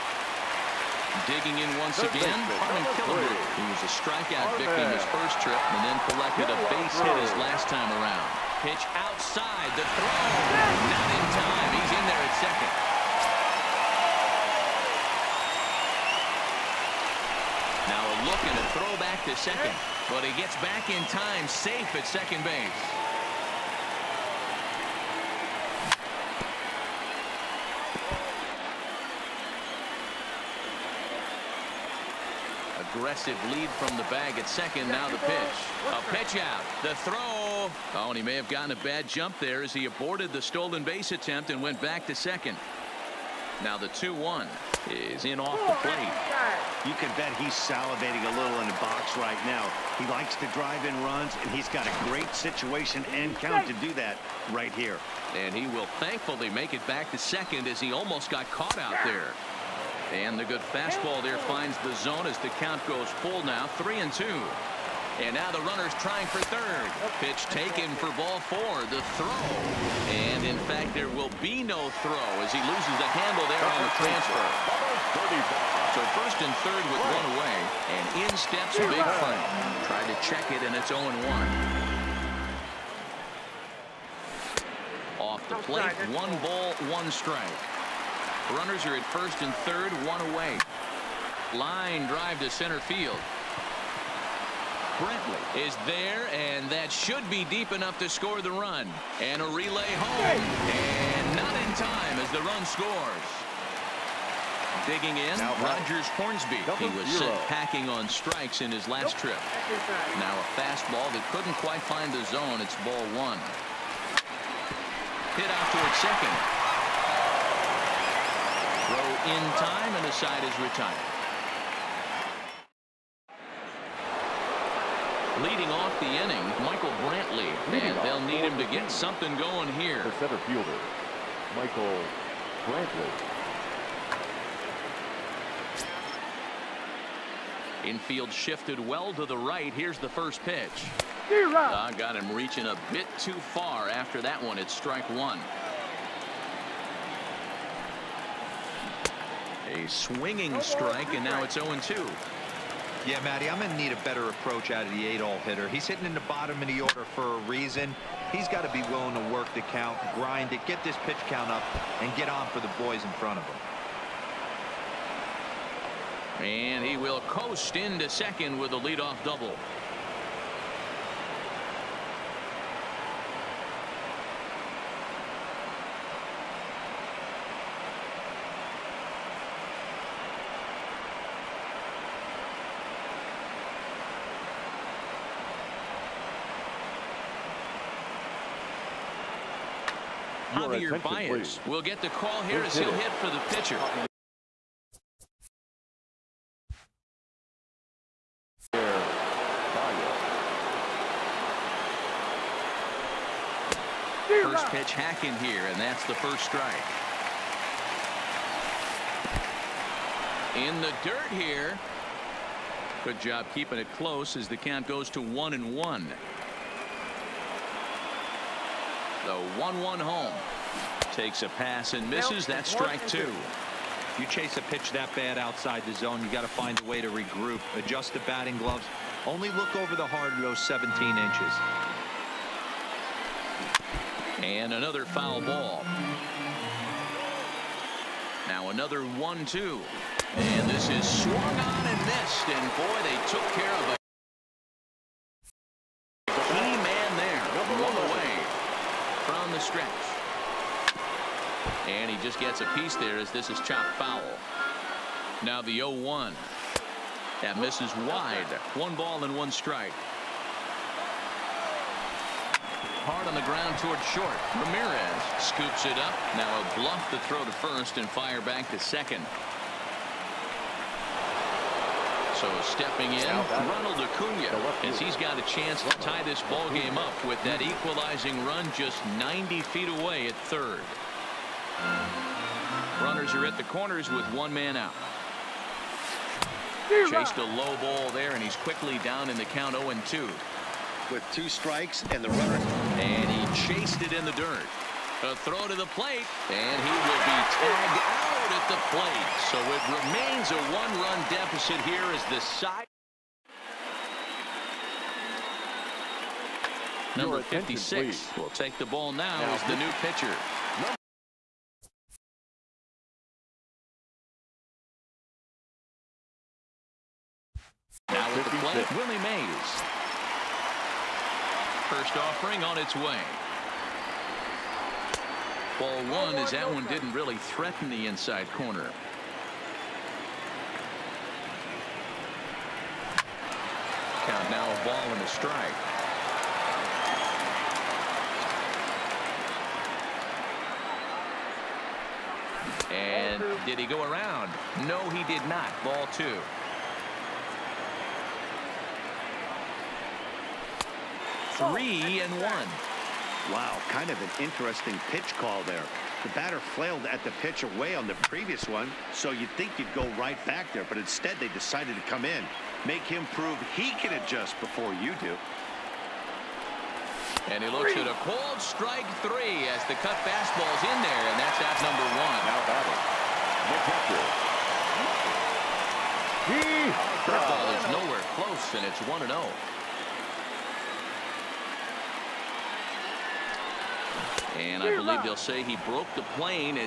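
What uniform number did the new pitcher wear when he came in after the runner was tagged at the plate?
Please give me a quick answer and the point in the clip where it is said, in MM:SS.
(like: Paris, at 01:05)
56, at 05:07.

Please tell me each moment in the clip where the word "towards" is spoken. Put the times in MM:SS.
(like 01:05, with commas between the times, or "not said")
01:55, 04:23.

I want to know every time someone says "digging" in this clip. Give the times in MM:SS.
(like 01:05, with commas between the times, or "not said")
00:01, 01:44.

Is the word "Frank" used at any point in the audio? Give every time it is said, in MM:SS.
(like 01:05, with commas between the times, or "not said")
01:19.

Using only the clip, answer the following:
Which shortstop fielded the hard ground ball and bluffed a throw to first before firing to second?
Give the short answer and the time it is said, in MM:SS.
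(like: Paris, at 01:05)
Ramirez, at 04:24.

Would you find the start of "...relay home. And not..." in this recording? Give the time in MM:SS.
01:39.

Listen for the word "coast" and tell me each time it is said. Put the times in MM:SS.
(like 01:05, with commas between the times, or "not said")
02:47.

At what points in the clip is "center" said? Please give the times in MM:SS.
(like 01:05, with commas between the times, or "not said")
01:32, 02:10.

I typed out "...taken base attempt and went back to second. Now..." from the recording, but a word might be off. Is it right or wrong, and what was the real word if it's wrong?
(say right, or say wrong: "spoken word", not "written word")
wrong: "stolen", not "taken".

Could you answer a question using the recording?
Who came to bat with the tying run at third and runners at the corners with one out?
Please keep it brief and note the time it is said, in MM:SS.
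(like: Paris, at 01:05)
Ronald Acuna, at 04:33.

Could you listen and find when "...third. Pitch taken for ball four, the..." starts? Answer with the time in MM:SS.
01:06.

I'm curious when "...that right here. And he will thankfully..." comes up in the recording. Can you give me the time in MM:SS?
00:53.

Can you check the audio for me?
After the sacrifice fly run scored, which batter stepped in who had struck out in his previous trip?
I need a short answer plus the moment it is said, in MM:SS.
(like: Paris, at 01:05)
Rogers Hornsby, at 01:45.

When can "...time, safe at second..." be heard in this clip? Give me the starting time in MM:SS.
00:21.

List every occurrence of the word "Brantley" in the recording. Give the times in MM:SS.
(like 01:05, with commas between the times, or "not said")
01:35, 02:07, 02:12.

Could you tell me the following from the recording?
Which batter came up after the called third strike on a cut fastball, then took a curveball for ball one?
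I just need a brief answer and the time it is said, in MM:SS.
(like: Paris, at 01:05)
McCutcheon, at 06:13.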